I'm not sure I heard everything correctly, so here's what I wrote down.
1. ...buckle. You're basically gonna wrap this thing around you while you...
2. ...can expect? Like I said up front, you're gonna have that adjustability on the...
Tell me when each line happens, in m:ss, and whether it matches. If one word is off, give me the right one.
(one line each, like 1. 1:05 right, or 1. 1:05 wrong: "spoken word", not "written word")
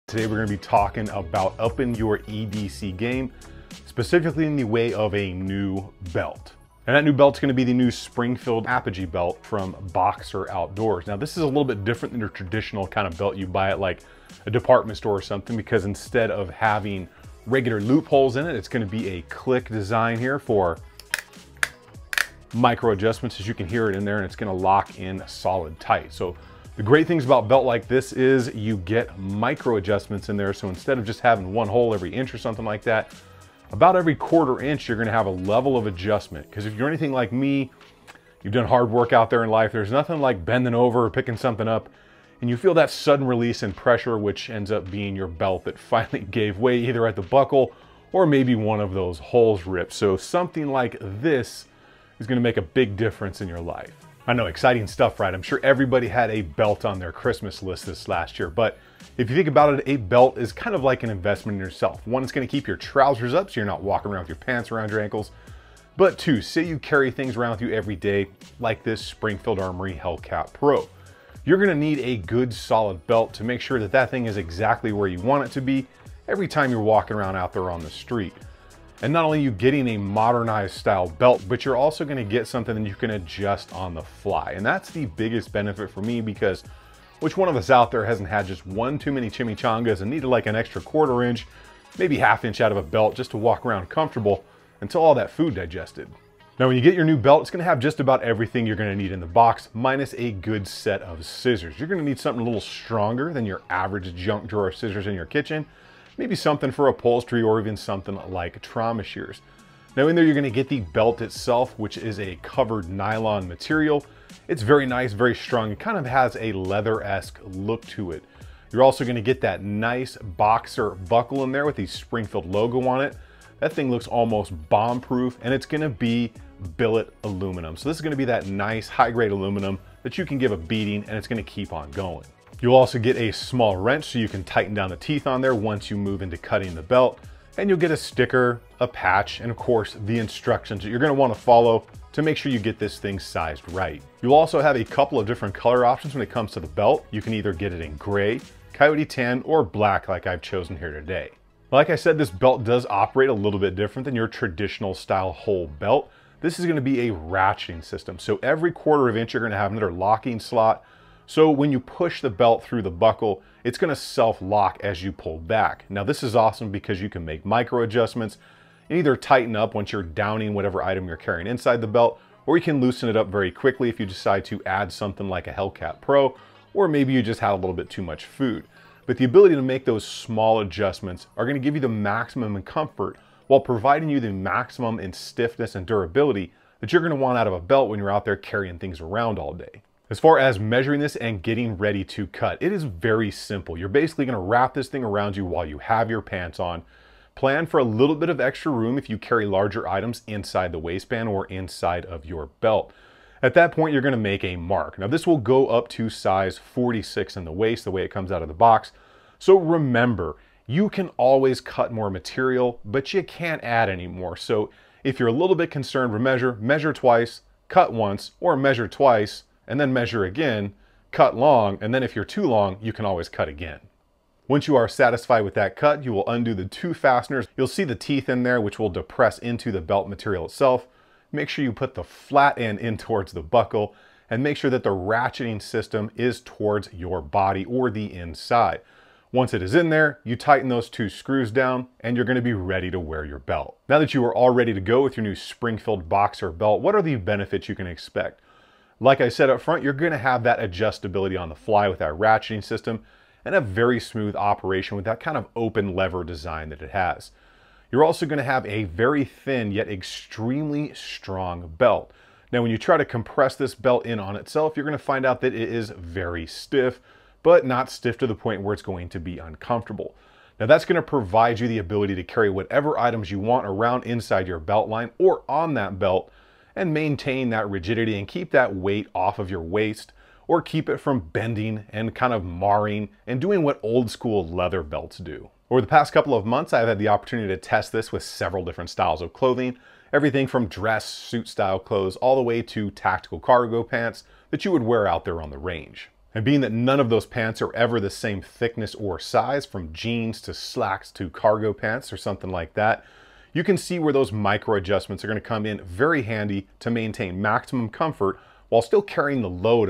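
1. 3:13 wrong: "simple", not "buckle"
2. 4:07 right.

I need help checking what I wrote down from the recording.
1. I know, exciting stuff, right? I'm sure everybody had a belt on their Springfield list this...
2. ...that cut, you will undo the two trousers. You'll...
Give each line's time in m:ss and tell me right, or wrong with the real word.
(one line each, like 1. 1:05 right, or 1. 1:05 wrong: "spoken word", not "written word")
1. 0:54 wrong: "Christmas", not "Springfield"
2. 3:45 wrong: "fasteners", not "trousers".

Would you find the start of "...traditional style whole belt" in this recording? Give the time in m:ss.
2:34.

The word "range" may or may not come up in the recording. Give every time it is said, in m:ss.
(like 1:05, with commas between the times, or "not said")
4:55.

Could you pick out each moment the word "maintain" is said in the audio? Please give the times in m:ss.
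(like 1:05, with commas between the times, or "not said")
4:36, 5:06.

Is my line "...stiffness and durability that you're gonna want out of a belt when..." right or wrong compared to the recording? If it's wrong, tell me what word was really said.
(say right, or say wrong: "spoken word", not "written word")
right.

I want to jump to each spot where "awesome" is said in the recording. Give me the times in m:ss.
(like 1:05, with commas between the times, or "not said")
2:46.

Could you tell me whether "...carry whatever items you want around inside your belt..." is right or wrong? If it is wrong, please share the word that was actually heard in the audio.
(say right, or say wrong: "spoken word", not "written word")
right.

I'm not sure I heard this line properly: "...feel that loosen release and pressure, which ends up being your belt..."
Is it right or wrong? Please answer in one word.
wrong.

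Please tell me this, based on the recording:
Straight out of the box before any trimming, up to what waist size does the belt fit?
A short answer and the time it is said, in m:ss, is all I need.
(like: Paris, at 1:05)
46, at 3:26.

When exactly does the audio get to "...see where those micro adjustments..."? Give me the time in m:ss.
5:03.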